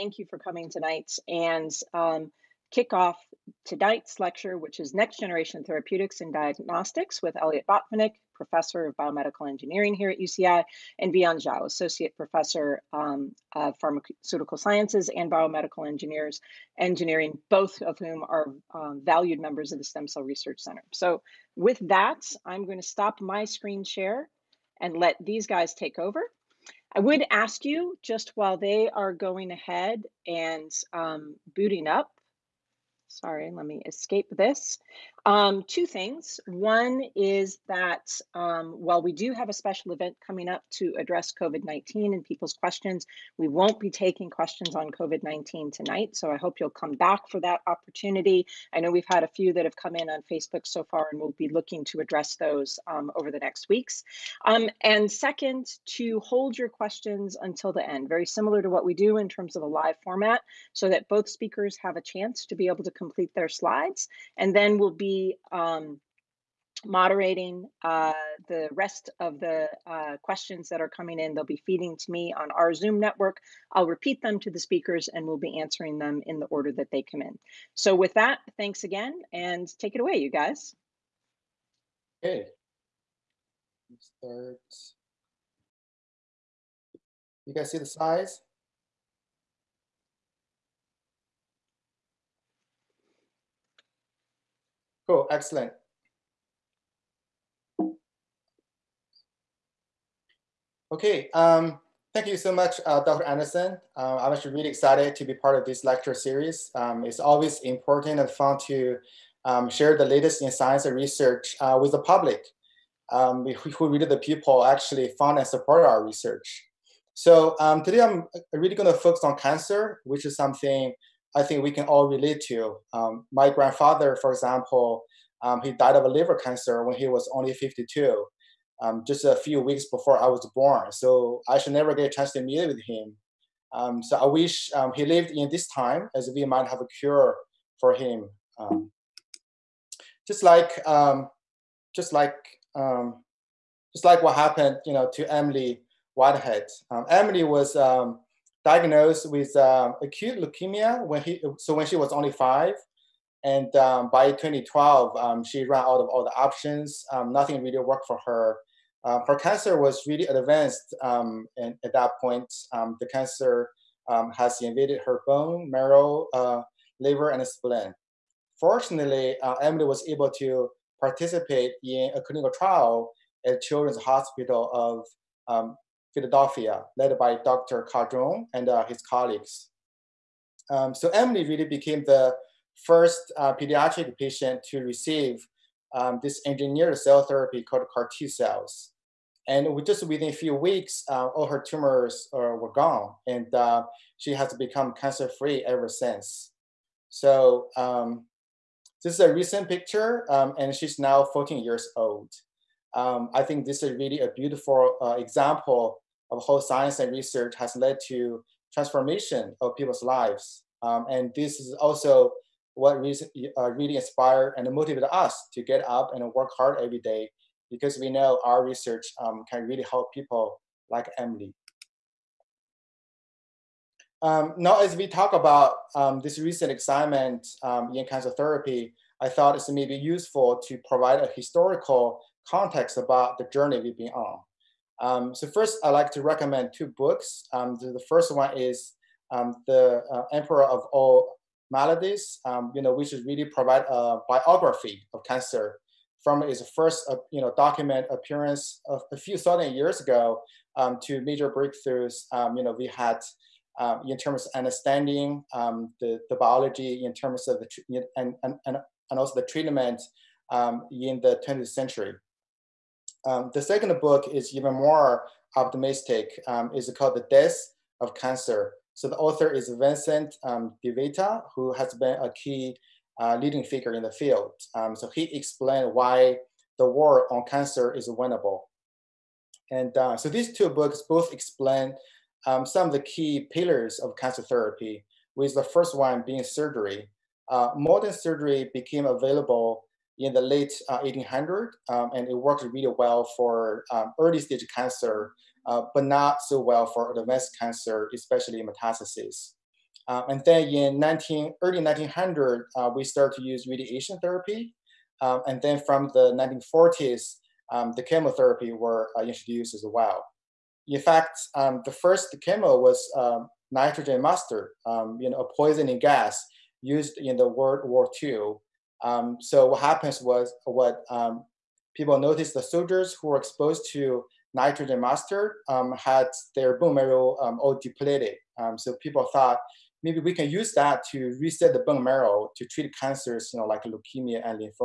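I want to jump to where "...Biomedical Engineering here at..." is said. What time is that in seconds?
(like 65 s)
8 s.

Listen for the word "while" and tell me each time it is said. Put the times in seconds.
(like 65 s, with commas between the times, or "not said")
28 s, 38 s.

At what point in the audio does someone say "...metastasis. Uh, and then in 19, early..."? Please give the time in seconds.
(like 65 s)
298 s.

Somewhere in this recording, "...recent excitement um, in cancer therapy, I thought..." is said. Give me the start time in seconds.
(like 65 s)
226 s.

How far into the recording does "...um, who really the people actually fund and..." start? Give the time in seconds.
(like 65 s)
113 s.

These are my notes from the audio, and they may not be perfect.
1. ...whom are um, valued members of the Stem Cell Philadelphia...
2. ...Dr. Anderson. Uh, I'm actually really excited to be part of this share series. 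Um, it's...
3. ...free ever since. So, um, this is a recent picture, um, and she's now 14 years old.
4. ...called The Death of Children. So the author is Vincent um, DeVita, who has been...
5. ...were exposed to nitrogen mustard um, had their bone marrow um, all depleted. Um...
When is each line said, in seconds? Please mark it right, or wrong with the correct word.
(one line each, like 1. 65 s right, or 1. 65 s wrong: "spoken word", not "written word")
1. 17 s wrong: "Research", not "Philadelphia"
2. 103 s wrong: "lecture", not "share"
3. 195 s right
4. 266 s wrong: "Cancer", not "Children"
5. 323 s right.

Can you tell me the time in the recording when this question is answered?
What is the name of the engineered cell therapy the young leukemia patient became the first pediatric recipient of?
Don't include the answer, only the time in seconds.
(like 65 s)
187 s.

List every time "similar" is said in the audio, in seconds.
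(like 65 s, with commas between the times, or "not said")
58 s.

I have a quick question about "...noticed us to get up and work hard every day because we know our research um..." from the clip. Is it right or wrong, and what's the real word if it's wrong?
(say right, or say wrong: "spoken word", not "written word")
wrong: "motivated", not "noticed".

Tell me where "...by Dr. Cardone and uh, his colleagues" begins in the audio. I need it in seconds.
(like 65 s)
177 s.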